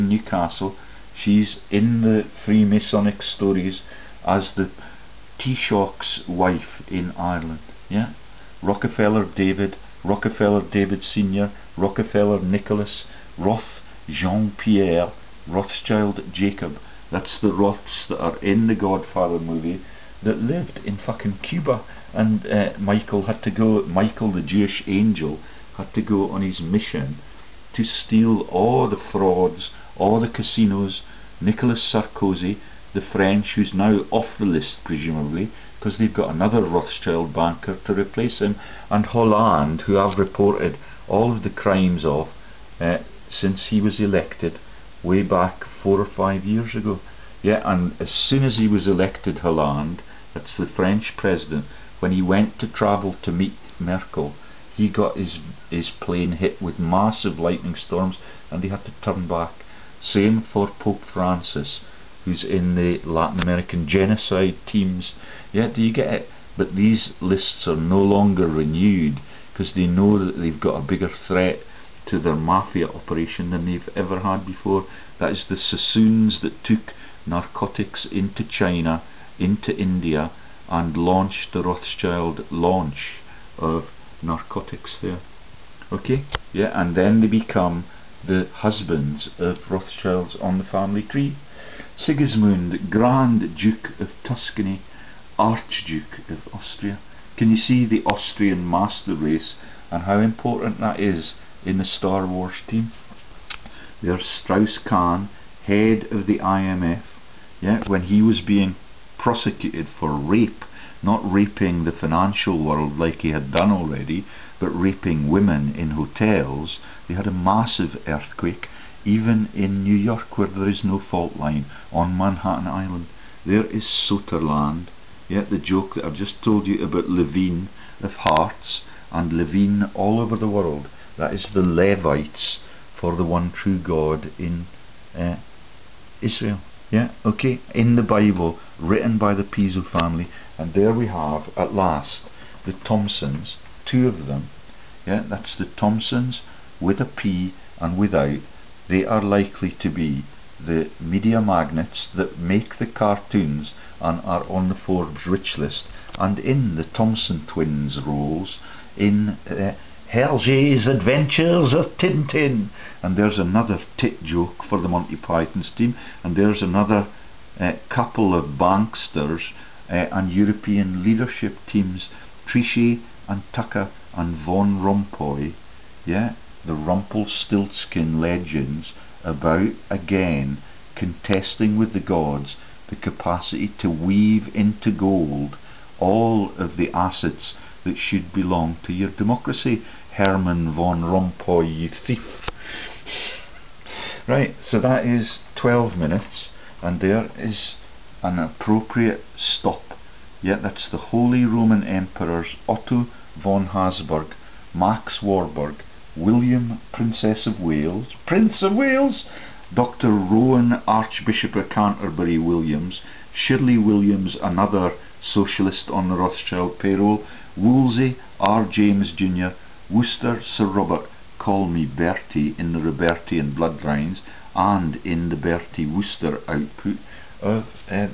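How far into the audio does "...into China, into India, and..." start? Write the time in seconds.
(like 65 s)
78 s.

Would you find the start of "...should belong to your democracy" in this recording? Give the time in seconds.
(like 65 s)
187 s.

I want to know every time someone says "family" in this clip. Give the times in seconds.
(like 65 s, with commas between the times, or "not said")
90 s, 139 s.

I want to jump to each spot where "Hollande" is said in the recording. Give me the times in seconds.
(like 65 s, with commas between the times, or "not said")
39 s, 49 s.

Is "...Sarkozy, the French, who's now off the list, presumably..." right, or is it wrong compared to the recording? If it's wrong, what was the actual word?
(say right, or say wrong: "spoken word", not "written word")
right.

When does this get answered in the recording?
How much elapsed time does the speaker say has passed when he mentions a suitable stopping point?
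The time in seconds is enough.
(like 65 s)
195 s.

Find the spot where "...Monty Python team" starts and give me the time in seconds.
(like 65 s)
164 s.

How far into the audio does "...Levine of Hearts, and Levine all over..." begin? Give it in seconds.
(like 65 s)
127 s.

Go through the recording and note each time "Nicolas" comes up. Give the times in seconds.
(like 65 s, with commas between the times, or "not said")
31 s.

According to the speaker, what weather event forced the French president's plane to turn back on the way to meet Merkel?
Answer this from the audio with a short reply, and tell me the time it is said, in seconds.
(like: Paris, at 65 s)
Lightning storms, at 57 s.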